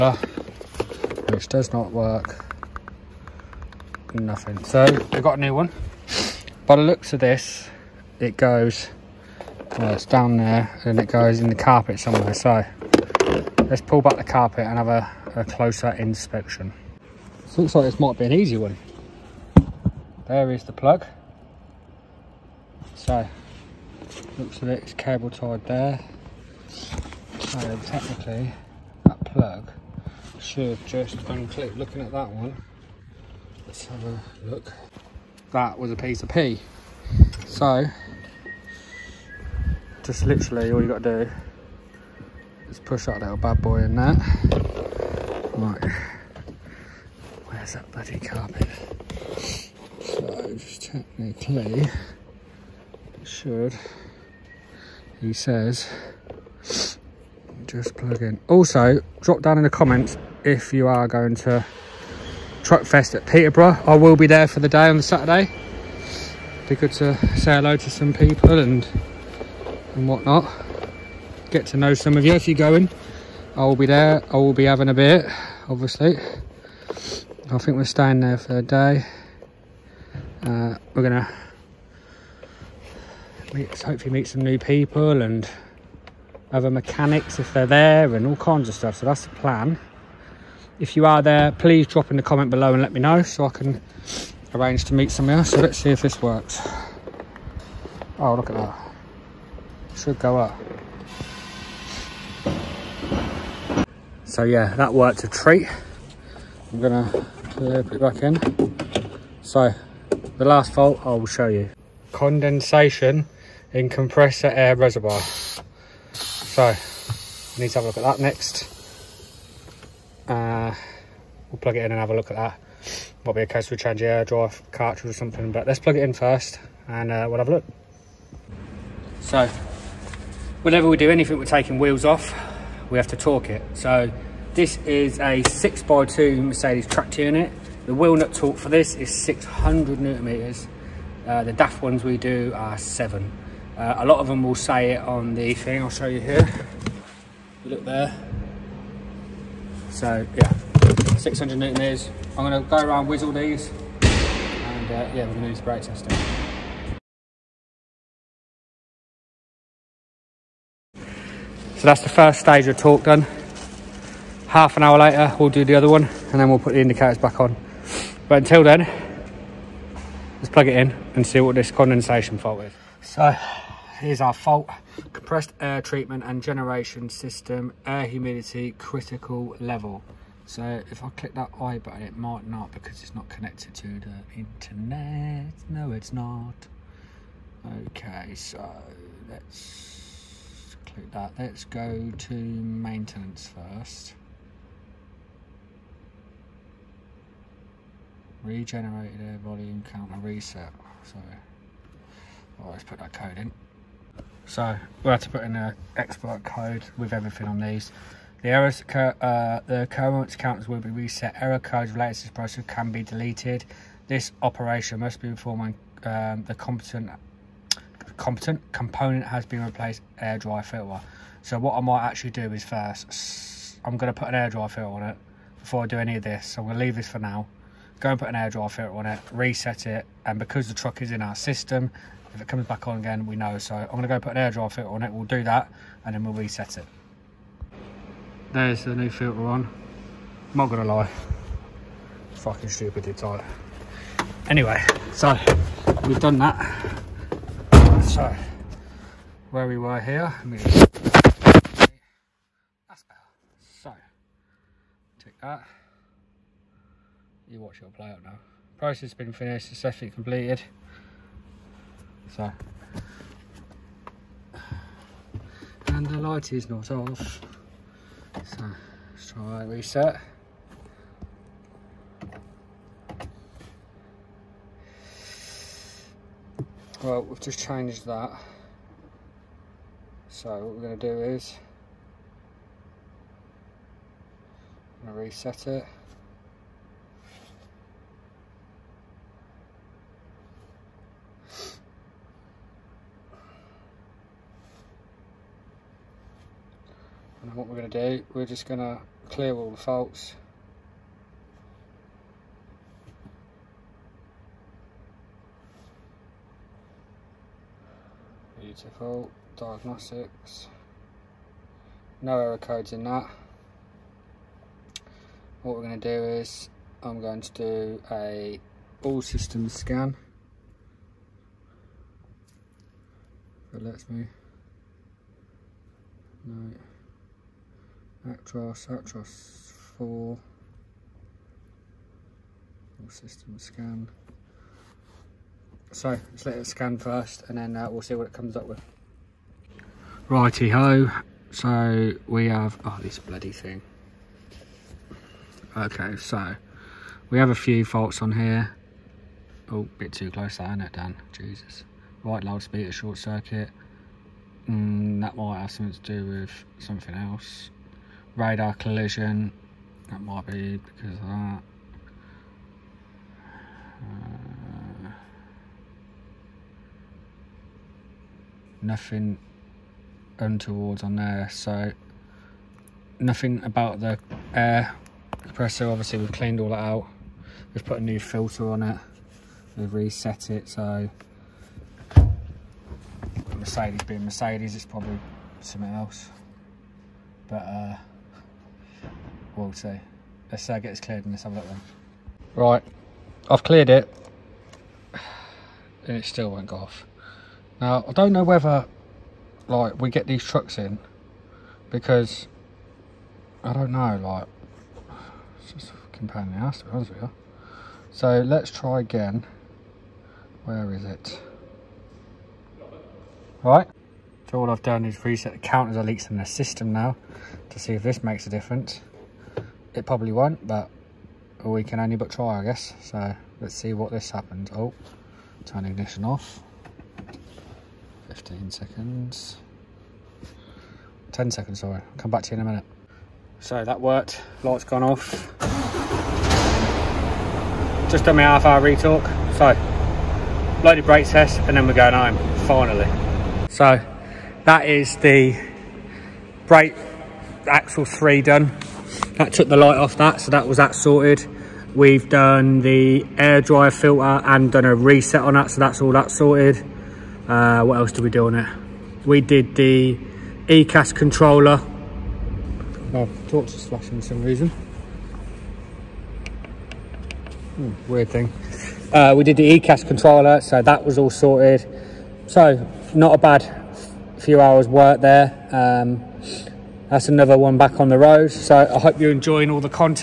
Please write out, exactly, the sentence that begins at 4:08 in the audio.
So, where we were here, that's better.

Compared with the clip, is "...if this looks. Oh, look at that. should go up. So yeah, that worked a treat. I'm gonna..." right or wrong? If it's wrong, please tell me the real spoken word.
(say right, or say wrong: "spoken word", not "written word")
wrong: "works", not "looks".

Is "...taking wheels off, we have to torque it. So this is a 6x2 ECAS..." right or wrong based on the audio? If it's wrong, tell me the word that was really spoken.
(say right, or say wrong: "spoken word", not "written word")
wrong: "Mercedes", not "ECAS".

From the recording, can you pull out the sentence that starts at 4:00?
I'm not gonna lie, fucking stupidly tight.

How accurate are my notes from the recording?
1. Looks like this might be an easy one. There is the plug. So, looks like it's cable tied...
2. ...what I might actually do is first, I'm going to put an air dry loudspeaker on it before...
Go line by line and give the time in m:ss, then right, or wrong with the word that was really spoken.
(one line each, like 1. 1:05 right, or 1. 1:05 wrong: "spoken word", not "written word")
1. 0:17 right
2. 3:41 wrong: "filter", not "loudspeaker".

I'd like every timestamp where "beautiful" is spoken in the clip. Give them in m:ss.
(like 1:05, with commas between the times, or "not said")
5:08.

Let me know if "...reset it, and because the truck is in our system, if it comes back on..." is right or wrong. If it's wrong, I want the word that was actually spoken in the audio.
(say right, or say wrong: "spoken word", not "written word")
right.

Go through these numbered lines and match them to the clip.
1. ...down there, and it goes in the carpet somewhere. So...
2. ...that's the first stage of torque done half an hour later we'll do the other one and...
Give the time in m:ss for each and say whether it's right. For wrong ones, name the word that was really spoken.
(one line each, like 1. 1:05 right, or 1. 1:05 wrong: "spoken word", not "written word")
1. 0:10 right
2. 2:41 right.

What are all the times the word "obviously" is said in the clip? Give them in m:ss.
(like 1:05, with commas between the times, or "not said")
1:15, 6:15.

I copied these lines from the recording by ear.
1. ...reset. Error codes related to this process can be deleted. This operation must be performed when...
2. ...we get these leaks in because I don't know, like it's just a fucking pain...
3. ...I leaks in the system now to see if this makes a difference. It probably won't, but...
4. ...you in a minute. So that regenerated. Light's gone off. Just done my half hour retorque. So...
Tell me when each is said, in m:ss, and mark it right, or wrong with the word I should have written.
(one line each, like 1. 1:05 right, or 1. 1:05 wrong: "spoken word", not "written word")
1. 3:30 right
2. 6:40 wrong: "trucks", not "leaks"
3. 6:55 right
4. 7:12 wrong: "worked", not "regenerated".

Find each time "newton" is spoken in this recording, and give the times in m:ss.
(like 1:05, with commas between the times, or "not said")
2:20, 2:31.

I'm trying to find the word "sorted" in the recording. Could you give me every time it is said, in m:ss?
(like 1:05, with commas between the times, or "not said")
7:30, 7:36, 7:51.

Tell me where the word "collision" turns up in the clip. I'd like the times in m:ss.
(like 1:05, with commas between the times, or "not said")
5:58.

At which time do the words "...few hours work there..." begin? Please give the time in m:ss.
7:54.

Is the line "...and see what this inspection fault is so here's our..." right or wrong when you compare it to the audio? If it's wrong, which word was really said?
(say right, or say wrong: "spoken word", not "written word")
wrong: "condensation", not "inspection".